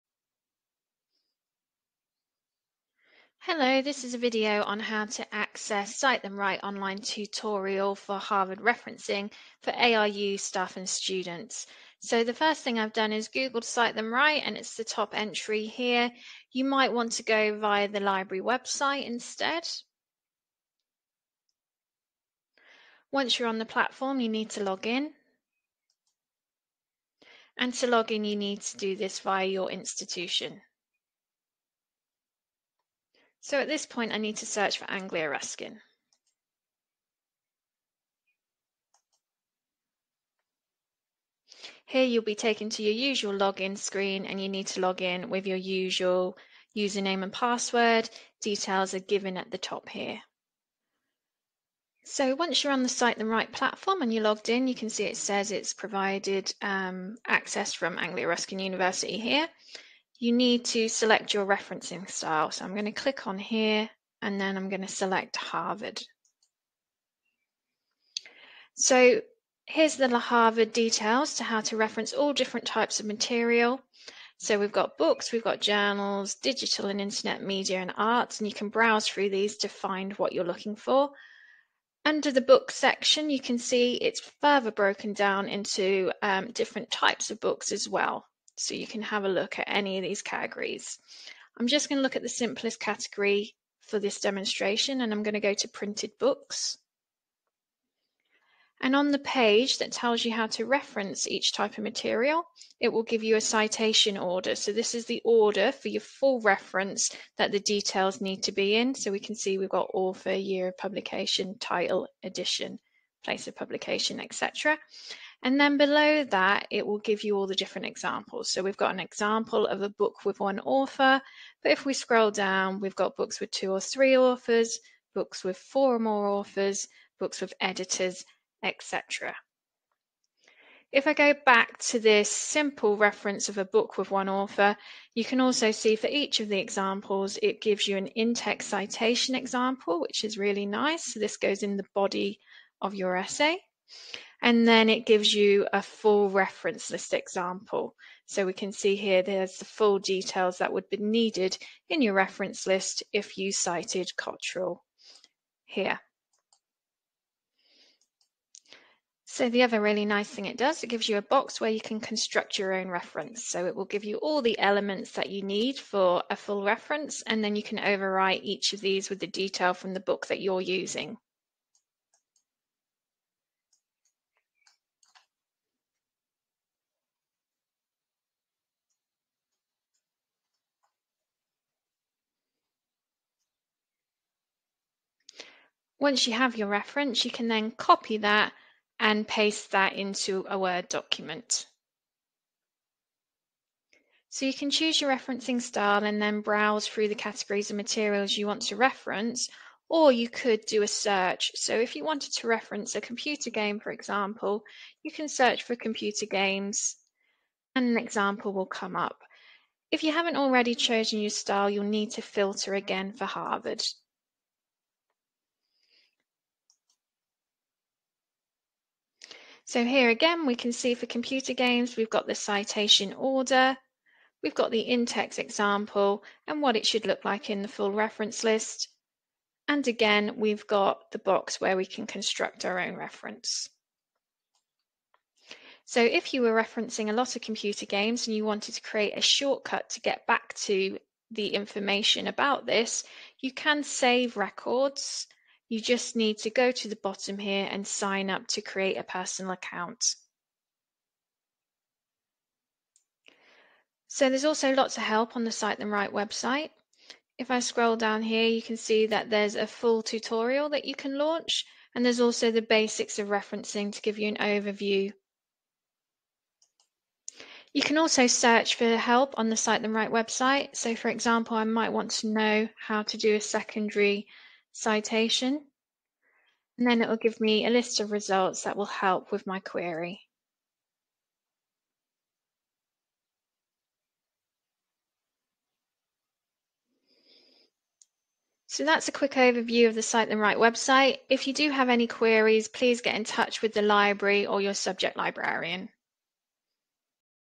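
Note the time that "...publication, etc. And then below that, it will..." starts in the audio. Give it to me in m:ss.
1:53.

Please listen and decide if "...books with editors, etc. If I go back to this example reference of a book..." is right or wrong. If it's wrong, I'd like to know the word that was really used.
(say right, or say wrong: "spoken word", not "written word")
wrong: "simple", not "example".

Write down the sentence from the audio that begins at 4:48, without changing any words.
So that's a quick overview of the Cite Them Right website.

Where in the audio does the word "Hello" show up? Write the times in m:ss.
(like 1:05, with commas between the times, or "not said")
0:03.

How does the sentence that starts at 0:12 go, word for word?
So the first thing I've done is Googled Cite Them Right and it's the top entry here.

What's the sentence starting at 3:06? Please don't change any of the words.
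Once you have your reference, you can then copy that and paste that into a Word document.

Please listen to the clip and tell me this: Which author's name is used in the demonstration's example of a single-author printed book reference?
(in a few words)
Cottrell.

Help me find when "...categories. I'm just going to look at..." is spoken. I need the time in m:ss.
1:30.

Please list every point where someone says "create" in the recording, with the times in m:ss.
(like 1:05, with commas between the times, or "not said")
3:58, 4:08.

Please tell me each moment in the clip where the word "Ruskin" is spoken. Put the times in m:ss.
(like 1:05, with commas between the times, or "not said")
0:35, 0:58.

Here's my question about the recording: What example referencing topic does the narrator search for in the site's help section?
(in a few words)
Secondary citation.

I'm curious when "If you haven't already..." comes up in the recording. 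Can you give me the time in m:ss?
3:29.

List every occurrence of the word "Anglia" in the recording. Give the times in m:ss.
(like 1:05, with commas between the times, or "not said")
0:34, 0:57.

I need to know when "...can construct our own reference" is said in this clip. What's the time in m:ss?
3:51.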